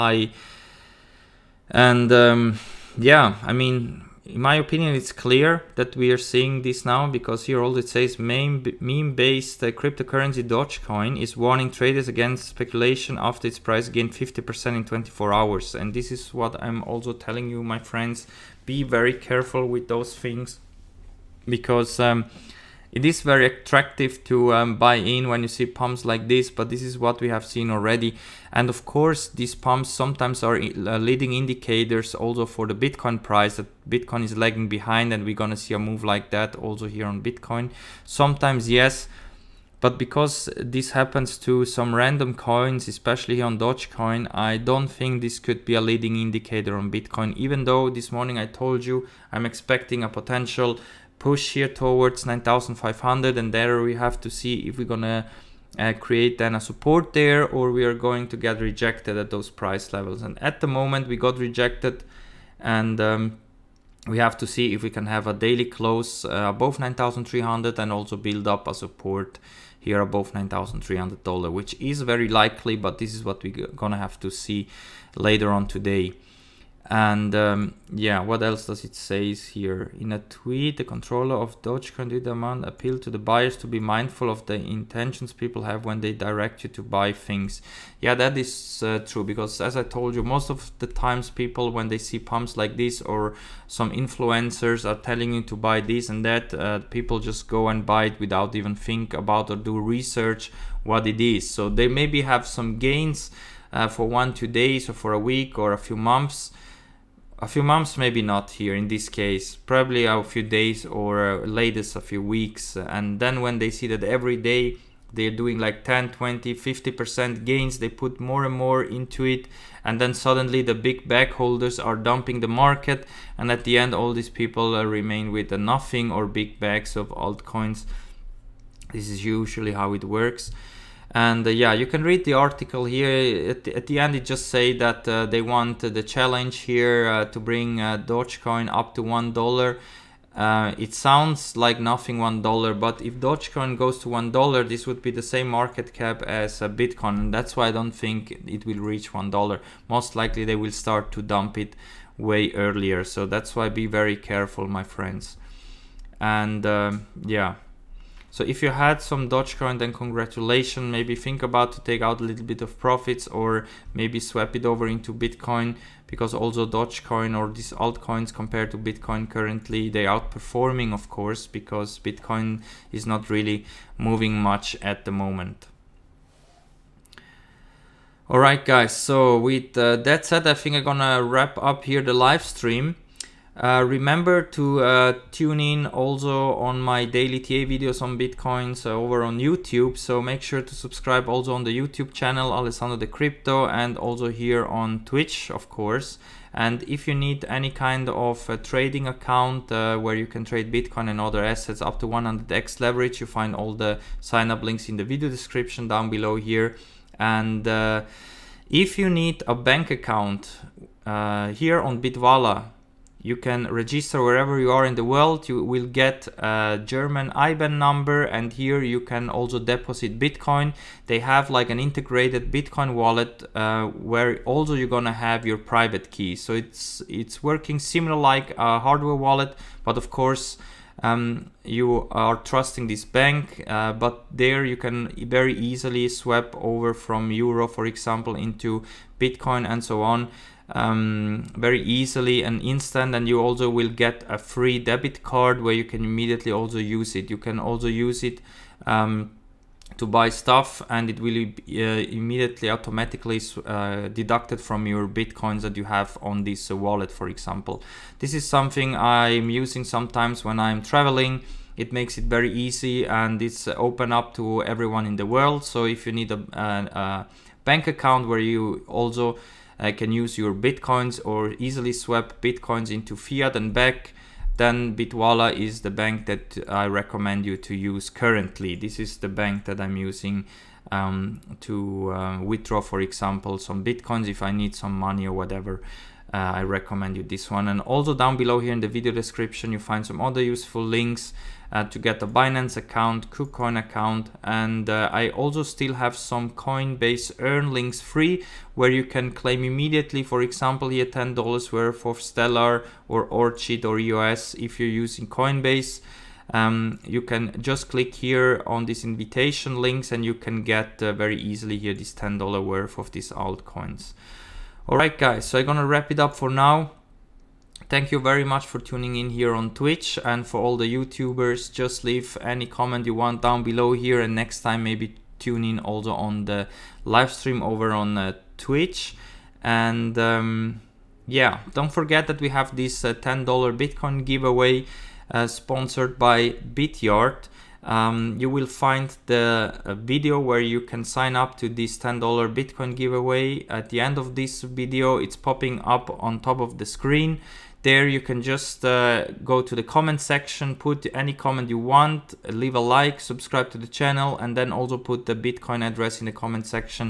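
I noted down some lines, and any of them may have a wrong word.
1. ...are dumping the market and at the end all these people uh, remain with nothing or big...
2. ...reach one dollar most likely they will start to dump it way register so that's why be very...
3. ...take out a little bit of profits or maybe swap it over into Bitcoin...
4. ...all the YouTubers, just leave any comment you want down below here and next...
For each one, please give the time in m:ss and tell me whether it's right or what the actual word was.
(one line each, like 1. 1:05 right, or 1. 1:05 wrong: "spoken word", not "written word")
1. 2:01 right
2. 2:28 wrong: "earlier", not "register"
3. 2:41 right
4. 5:20 right.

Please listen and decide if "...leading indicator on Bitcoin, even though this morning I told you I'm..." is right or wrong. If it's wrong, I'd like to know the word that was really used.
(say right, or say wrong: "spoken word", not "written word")
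right.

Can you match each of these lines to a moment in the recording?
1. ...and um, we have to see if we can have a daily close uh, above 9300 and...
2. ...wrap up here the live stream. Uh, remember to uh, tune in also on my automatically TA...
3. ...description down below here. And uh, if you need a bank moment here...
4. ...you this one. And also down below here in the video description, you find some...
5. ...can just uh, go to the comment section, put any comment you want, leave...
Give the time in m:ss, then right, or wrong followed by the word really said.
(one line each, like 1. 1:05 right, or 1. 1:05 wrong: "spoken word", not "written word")
1. 1:02 right
2. 3:01 wrong: "daily", not "automatically"
3. 3:25 wrong: "account", not "moment"
4. 4:47 right
5. 5:48 right.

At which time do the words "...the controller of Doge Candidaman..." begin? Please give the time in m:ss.
1:20.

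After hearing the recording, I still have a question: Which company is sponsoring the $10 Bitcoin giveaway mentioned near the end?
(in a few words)
Bityard.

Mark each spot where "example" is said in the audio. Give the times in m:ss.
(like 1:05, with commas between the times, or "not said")
3:57, 4:17, 4:43, 5:00.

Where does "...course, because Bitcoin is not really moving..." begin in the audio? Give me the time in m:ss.
2:51.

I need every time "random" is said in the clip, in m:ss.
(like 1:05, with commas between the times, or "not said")
0:41.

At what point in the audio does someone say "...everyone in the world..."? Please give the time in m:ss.
4:24.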